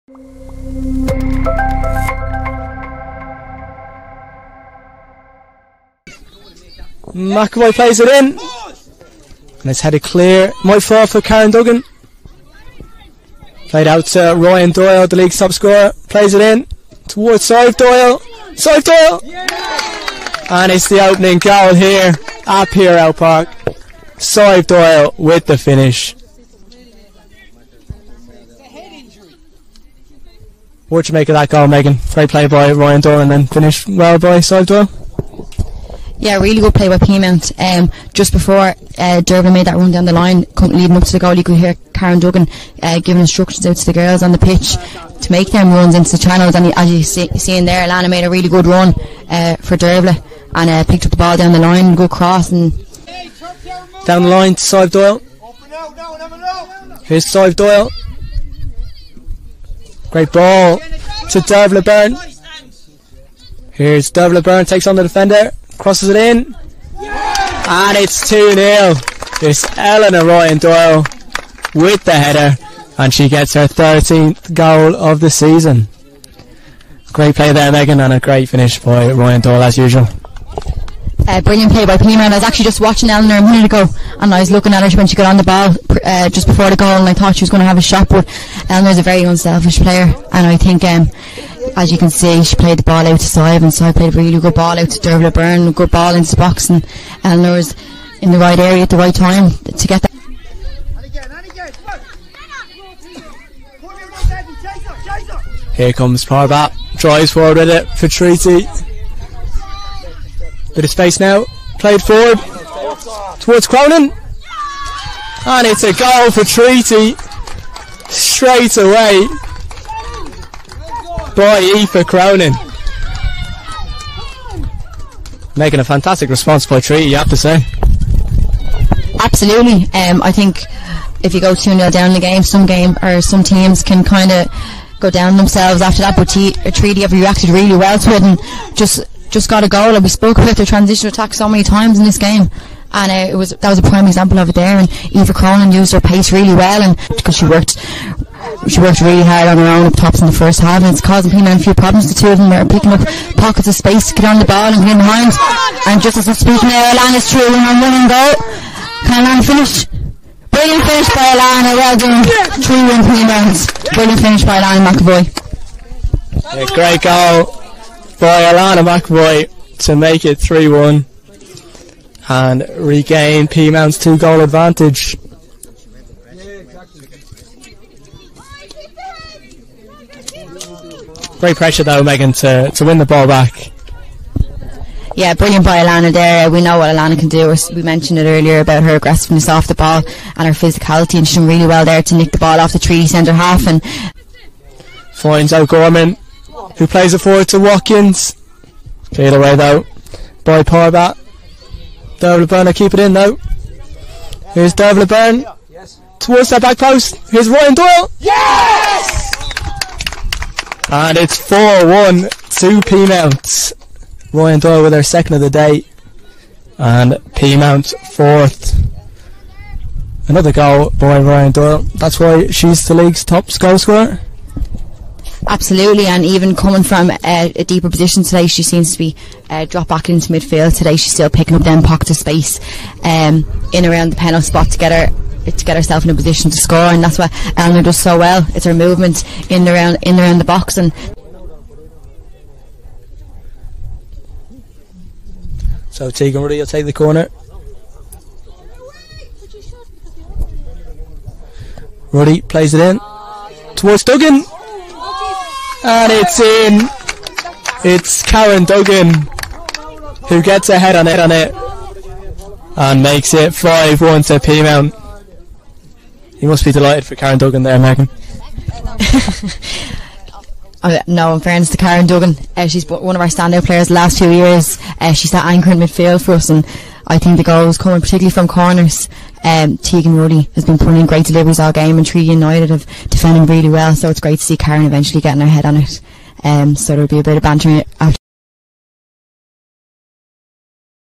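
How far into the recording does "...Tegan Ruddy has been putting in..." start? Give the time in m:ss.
4:39.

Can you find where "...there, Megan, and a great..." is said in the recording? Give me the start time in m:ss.
1:17.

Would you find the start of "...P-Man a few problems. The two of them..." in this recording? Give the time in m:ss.
2:31.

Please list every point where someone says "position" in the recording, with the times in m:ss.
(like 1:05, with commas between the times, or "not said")
3:47, 3:56.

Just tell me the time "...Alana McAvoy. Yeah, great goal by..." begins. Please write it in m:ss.
2:44.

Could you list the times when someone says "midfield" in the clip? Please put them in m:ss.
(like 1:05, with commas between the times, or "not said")
3:50, 4:35.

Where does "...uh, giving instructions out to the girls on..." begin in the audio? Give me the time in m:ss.
0:42.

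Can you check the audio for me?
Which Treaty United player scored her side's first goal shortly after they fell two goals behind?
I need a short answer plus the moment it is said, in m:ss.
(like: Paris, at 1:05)
Eva Cronin, at 2:25.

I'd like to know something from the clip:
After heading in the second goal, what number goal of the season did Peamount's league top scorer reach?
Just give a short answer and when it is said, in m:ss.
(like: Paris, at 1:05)
13th, at 1:13.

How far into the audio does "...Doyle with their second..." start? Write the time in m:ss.
3:34.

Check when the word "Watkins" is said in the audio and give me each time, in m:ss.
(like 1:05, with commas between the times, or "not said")
3:17.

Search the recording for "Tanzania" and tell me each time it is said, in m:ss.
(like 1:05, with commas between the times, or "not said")
not said.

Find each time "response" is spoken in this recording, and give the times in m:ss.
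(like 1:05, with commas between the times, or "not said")
2:06.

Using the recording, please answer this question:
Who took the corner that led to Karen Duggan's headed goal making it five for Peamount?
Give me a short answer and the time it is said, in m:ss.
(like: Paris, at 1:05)
Tegan Roddy, at 4:06.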